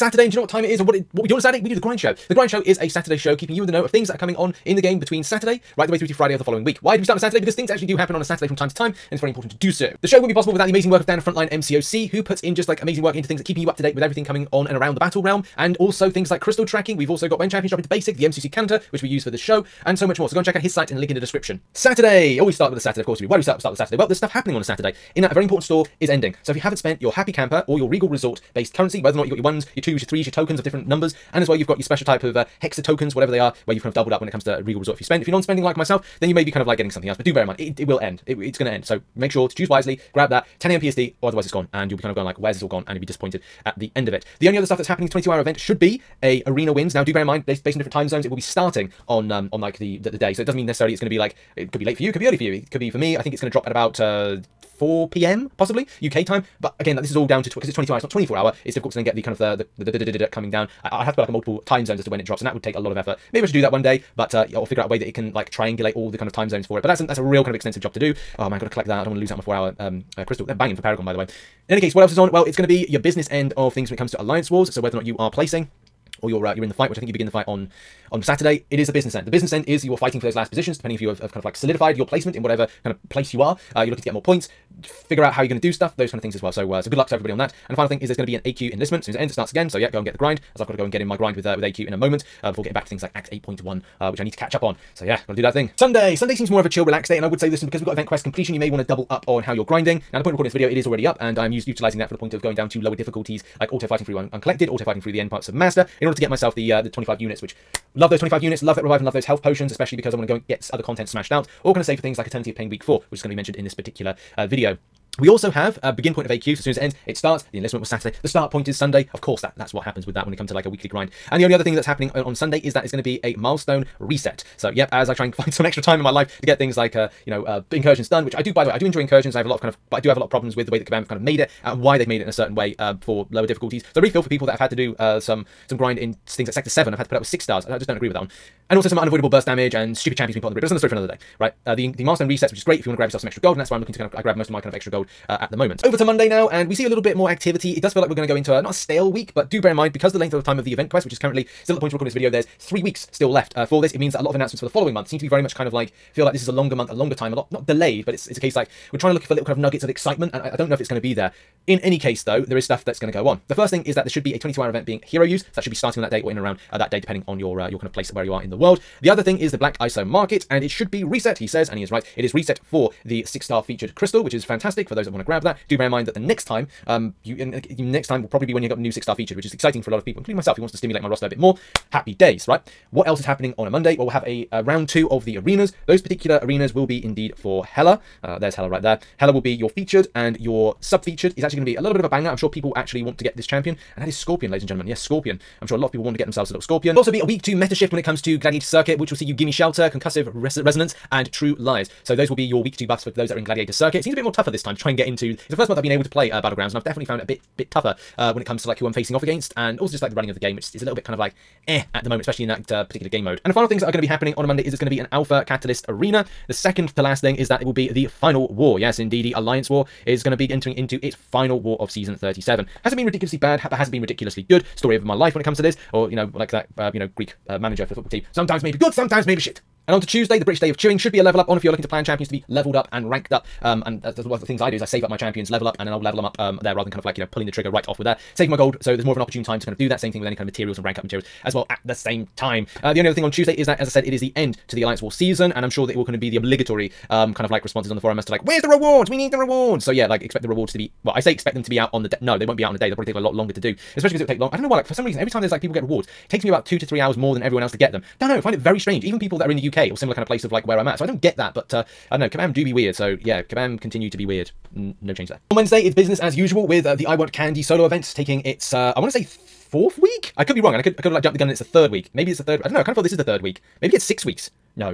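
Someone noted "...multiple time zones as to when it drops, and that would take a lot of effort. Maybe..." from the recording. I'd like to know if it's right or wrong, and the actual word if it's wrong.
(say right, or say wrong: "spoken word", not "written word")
right.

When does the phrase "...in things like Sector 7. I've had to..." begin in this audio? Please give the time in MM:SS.
02:15.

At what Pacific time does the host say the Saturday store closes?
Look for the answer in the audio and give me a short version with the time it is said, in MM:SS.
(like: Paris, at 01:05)
10 a.m. PST, at 00:40.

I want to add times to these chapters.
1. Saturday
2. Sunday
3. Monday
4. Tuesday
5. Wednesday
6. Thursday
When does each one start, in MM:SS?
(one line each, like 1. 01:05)
1. 00:21
2. 01:04
3. 01:35
4. 02:25
5. 03:49
6. 04:25.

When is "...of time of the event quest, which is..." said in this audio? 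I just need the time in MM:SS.
02:30.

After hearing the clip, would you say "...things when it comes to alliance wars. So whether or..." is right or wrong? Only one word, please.
right.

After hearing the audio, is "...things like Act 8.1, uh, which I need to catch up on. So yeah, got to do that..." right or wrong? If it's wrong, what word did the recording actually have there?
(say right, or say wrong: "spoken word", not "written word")
right.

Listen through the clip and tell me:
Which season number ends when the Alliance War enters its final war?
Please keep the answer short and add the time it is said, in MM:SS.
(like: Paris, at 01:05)
37, at 03:41.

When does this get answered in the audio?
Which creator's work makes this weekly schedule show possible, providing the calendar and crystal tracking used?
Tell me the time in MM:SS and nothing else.
00:11.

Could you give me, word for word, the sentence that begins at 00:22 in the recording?
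Always oh, start with a Saturday, of course.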